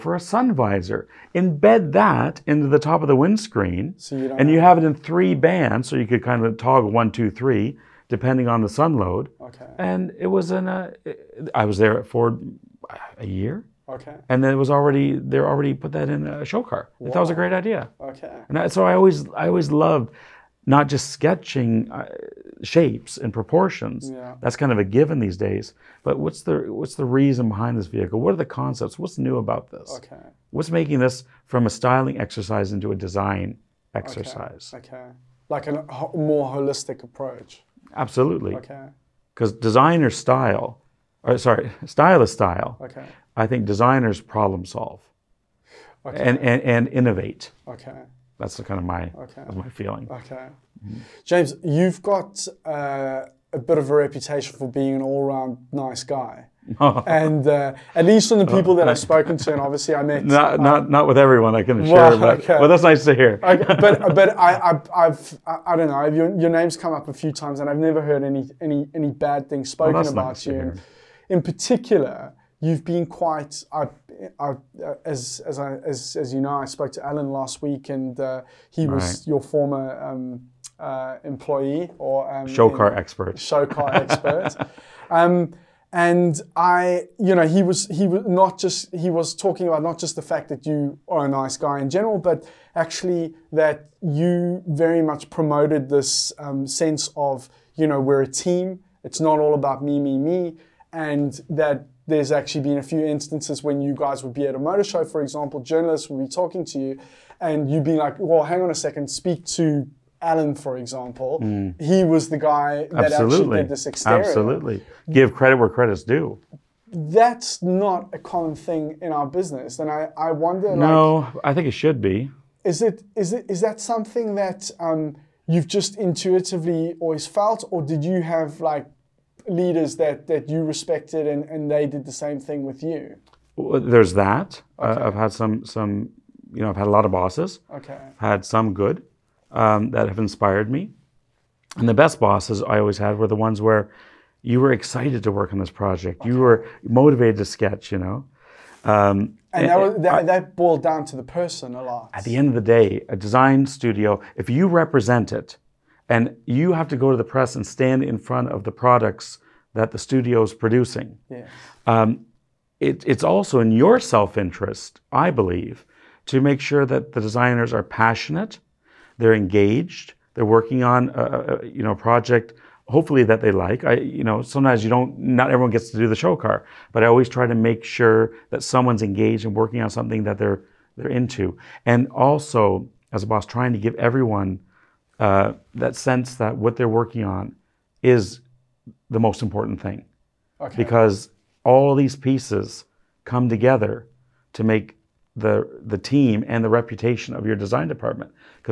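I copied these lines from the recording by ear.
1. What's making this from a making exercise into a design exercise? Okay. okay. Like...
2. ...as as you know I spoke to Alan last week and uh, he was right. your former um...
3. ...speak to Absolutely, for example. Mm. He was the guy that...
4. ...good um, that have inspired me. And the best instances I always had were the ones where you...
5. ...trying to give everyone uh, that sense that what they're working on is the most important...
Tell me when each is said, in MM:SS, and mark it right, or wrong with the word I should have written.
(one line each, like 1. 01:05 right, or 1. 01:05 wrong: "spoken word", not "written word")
1. 00:30 wrong: "styling", not "making"
2. 01:15 right
3. 01:49 wrong: "Alan", not "Absolutely"
4. 02:18 wrong: "bosses", not "instances"
5. 03:03 right.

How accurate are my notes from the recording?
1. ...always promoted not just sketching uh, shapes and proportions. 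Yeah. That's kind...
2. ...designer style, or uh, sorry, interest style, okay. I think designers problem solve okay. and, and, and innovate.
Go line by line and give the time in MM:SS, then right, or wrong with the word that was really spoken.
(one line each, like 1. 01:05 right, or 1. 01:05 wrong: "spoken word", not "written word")
1. 00:19 wrong: "loved", not "promoted"
2. 00:39 wrong: "stylist", not "interest".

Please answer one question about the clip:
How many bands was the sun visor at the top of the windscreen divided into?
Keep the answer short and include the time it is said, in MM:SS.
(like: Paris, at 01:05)
3, at 00:04.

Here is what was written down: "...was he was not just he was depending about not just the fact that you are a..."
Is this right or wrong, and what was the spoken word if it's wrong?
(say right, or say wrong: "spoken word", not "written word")
wrong: "talking", not "depending".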